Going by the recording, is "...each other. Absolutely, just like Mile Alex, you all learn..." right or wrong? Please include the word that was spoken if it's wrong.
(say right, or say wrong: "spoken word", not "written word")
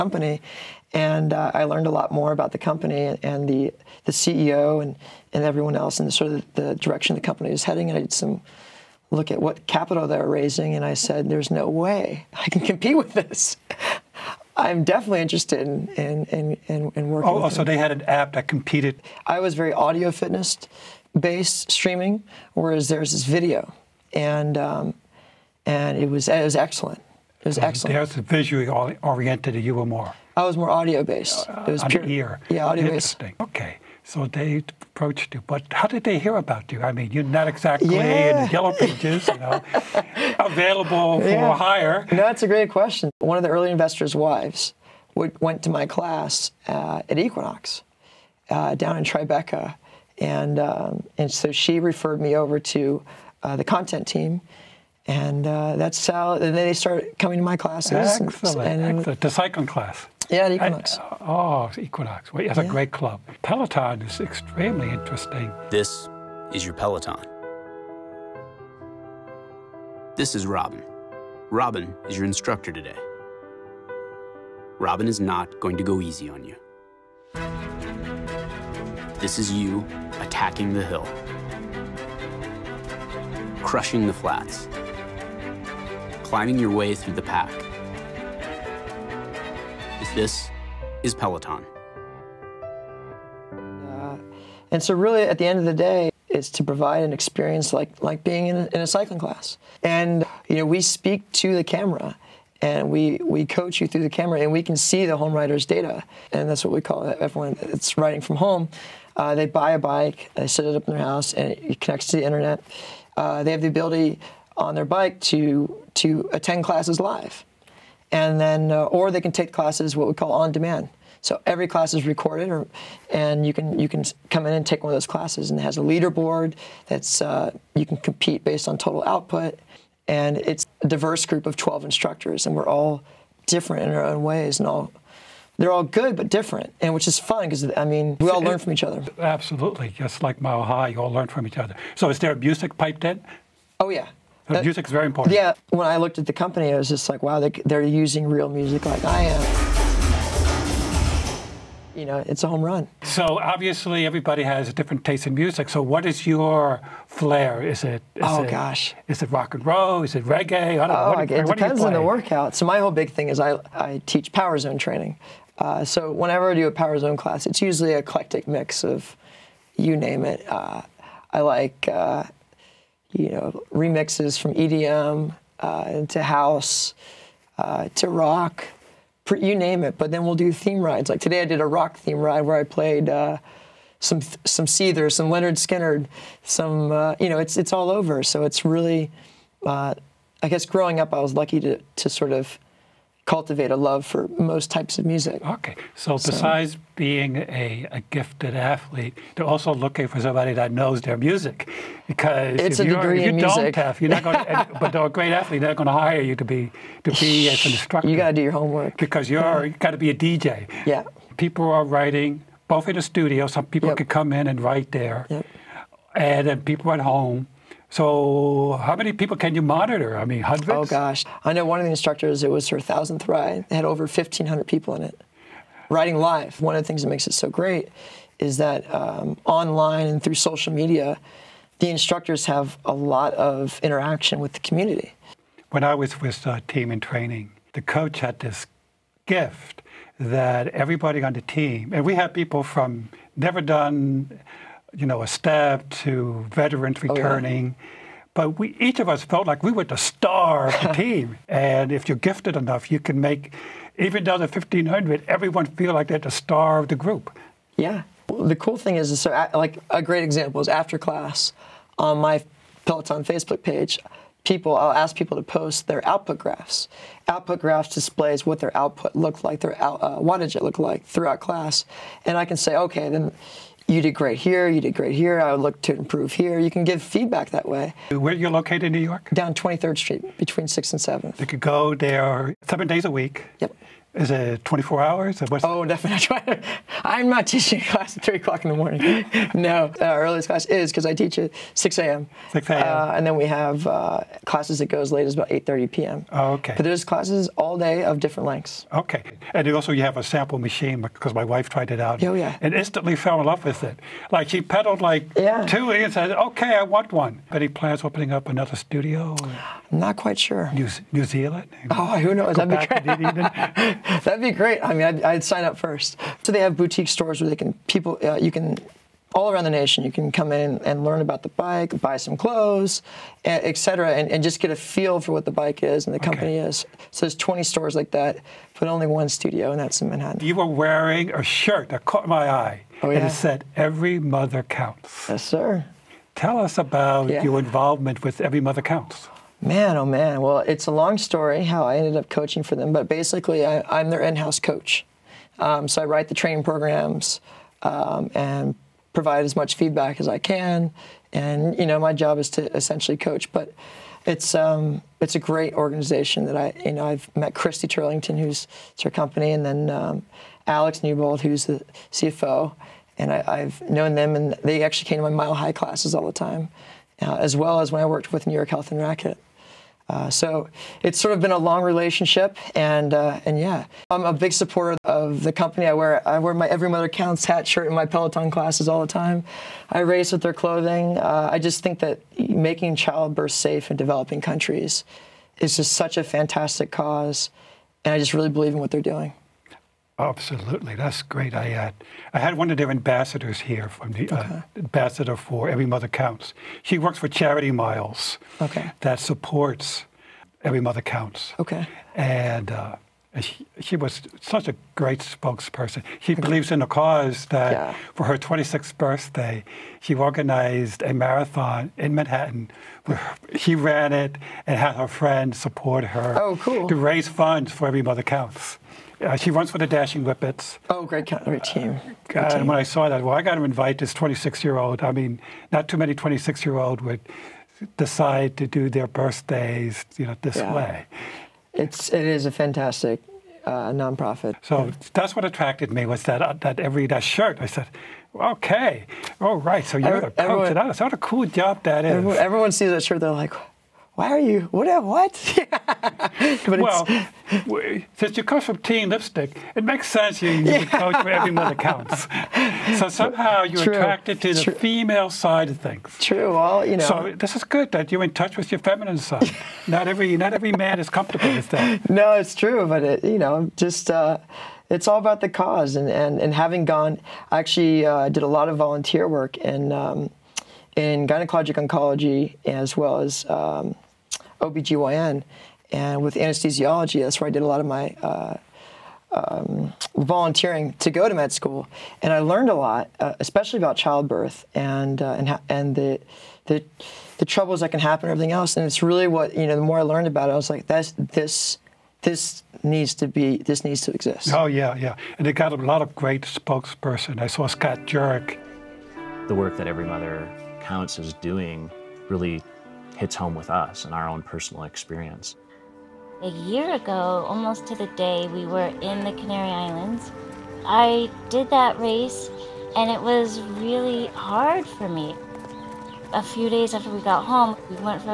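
wrong: "High", not "Alex".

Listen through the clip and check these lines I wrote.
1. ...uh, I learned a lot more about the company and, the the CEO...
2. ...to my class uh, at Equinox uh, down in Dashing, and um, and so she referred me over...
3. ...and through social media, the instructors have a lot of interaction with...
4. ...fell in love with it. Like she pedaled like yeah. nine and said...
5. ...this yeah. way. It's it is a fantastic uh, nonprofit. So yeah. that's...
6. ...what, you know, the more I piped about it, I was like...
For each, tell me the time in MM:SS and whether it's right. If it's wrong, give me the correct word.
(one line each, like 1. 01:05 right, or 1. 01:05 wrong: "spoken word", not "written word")
1. 00:01 right
2. 00:45 wrong: "Tribeca", not "Dashing"
3. 03:50 right
4. 05:03 wrong: "two", not "nine"
5. 07:10 right
6. 08:09 wrong: "learned", not "piped".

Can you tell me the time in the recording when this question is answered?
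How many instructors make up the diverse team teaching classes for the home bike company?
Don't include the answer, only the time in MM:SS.
02:11.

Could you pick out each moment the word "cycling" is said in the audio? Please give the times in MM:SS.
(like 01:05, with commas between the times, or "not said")
00:59, 01:38.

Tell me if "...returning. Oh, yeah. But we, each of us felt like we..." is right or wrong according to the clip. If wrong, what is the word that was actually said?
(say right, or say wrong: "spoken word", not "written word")
right.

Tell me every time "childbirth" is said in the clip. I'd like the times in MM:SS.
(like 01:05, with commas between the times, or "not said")
06:22, 08:03.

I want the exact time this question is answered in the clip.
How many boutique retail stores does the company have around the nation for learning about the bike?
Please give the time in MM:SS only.
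05:27.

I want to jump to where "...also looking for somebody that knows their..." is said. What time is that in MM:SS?
03:19.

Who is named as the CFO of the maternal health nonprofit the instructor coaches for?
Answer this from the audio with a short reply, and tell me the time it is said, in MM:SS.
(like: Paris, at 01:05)
Alex Newbold, at 06:00.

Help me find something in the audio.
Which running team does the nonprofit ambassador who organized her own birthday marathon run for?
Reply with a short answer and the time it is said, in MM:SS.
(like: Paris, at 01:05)
Dashing Whippets, at 06:59.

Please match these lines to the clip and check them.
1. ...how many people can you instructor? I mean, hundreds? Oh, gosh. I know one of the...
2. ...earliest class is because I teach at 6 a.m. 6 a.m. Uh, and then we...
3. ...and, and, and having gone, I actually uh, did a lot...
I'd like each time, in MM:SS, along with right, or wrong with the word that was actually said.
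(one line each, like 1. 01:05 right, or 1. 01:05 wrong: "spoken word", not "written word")
1. 03:38 wrong: "monitor", not "instructor"
2. 04:50 right
3. 07:45 right.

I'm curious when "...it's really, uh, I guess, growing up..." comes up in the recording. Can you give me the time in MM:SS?
03:08.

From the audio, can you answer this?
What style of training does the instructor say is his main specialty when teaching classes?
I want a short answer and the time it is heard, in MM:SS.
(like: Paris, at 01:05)
Power zone training, at 02:44.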